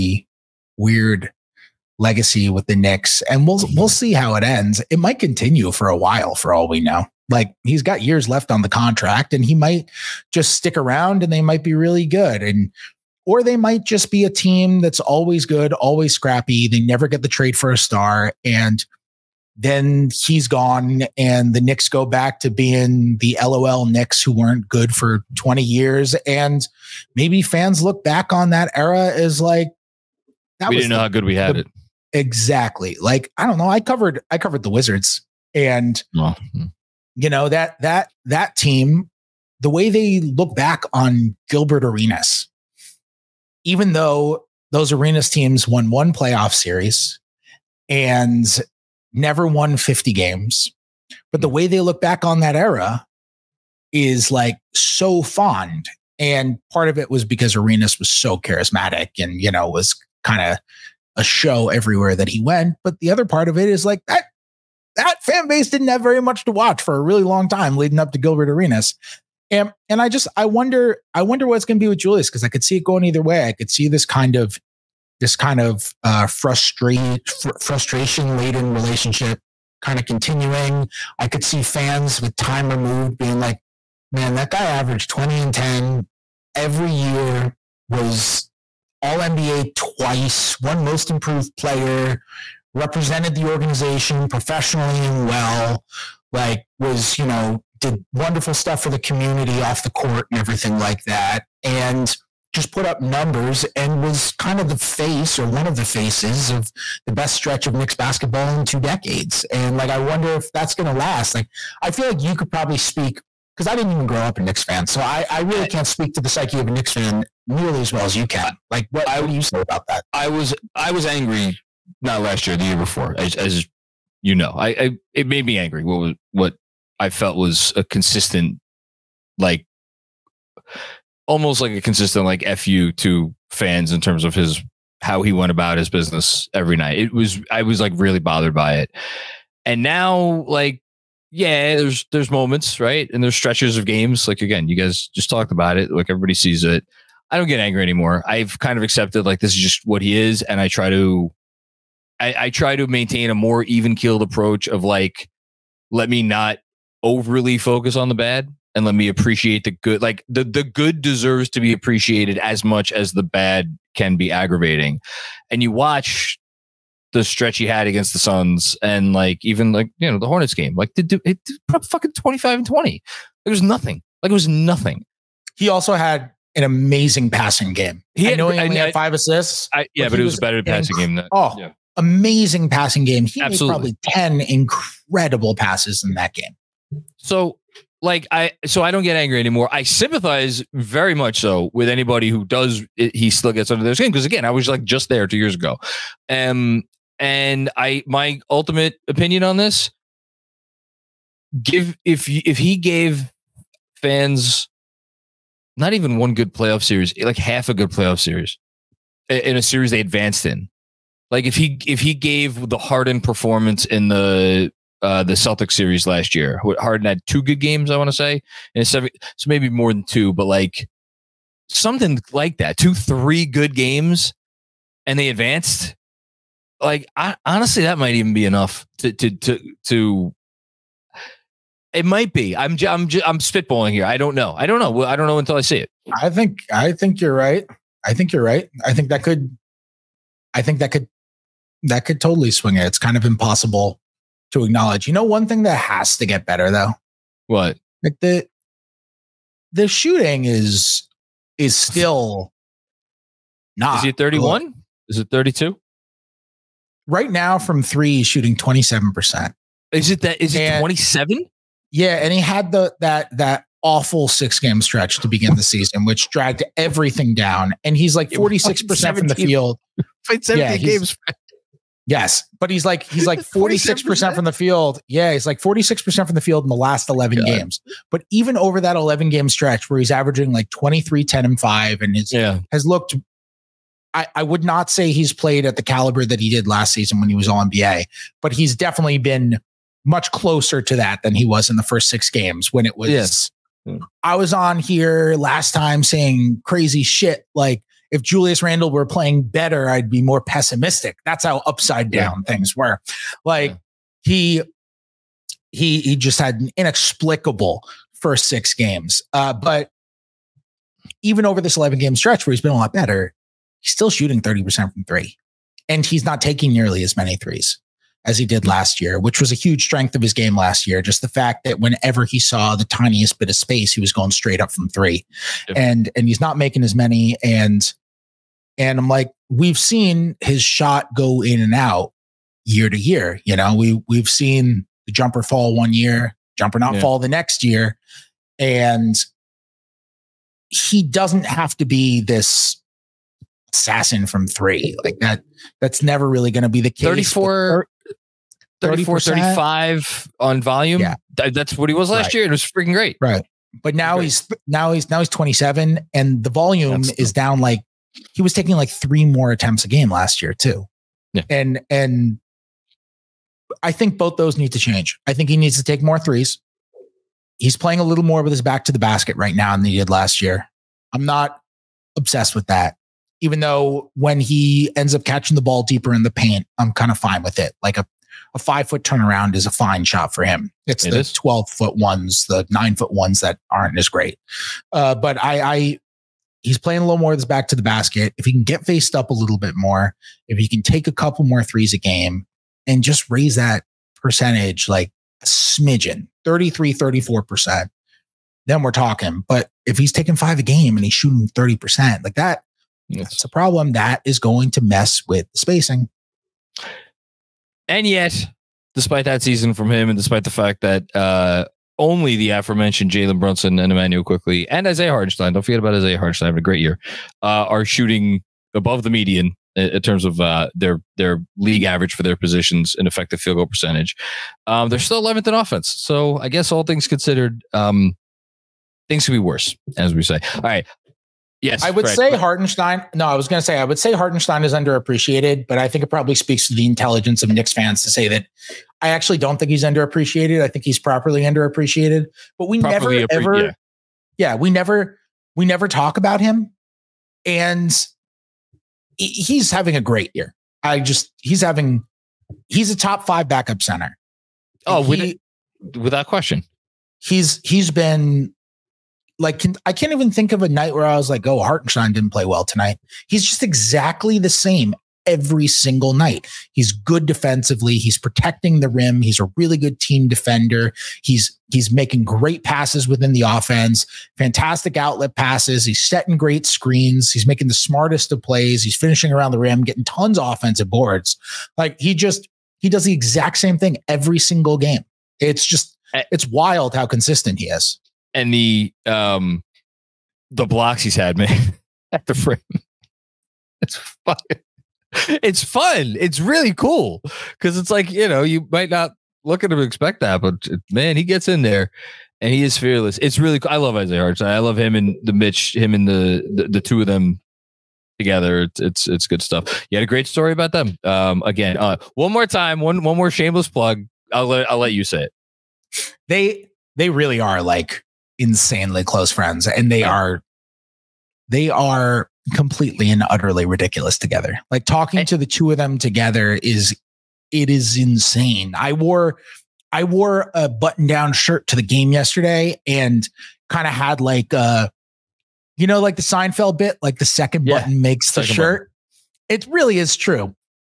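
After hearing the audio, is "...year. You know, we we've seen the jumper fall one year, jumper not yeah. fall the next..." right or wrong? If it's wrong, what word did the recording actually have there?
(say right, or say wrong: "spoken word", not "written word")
right.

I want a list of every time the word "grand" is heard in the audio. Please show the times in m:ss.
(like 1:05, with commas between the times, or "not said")
not said.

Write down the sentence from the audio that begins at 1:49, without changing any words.
And like, I wonder if that's going to last.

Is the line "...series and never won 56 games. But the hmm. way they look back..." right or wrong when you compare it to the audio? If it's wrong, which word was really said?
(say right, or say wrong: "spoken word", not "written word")
wrong: "50", not "56".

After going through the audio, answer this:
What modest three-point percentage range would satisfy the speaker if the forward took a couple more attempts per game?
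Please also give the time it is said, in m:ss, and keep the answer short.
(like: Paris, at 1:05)
33 to 34%, at 6:36.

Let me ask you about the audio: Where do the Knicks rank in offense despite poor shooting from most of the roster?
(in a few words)
11th.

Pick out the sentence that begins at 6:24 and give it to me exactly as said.
Uh, but I, I, he's playing a little more of this back to the basket.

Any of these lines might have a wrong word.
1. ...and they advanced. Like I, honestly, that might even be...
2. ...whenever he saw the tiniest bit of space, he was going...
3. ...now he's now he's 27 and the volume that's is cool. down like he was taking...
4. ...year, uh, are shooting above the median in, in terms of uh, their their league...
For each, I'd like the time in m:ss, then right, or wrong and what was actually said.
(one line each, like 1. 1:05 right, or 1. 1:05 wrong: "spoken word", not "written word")
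1. 3:45 right
2. 5:21 right
3. 5:54 right
4. 6:56 right.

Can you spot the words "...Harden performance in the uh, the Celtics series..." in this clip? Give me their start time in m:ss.
3:32.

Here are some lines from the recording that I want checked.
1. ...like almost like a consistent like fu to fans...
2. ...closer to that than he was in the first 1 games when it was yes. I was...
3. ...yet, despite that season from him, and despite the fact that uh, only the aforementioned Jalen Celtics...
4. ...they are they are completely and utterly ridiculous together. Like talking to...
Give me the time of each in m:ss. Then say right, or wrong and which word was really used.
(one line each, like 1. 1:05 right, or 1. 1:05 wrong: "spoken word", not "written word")
1. 2:09 right
2. 4:50 wrong: "6", not "1"
3. 6:48 wrong: "Brunson", not "Celtics"
4. 8:39 right.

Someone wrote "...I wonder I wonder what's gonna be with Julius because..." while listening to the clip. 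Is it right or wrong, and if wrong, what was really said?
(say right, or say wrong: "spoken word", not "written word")
right.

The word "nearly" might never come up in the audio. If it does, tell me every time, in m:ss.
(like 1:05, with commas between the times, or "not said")
1:57, 5:16.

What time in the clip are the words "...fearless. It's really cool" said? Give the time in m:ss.
8:22.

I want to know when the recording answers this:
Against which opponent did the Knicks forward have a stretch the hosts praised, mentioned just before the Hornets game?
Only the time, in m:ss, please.
2:48.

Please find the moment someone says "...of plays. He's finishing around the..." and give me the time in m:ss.
7:58.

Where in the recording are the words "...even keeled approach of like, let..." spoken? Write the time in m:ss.
2:33.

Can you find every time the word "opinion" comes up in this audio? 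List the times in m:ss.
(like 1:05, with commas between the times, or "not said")
3:19.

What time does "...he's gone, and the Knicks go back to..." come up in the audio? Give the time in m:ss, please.
0:20.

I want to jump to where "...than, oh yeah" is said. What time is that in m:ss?
3:01.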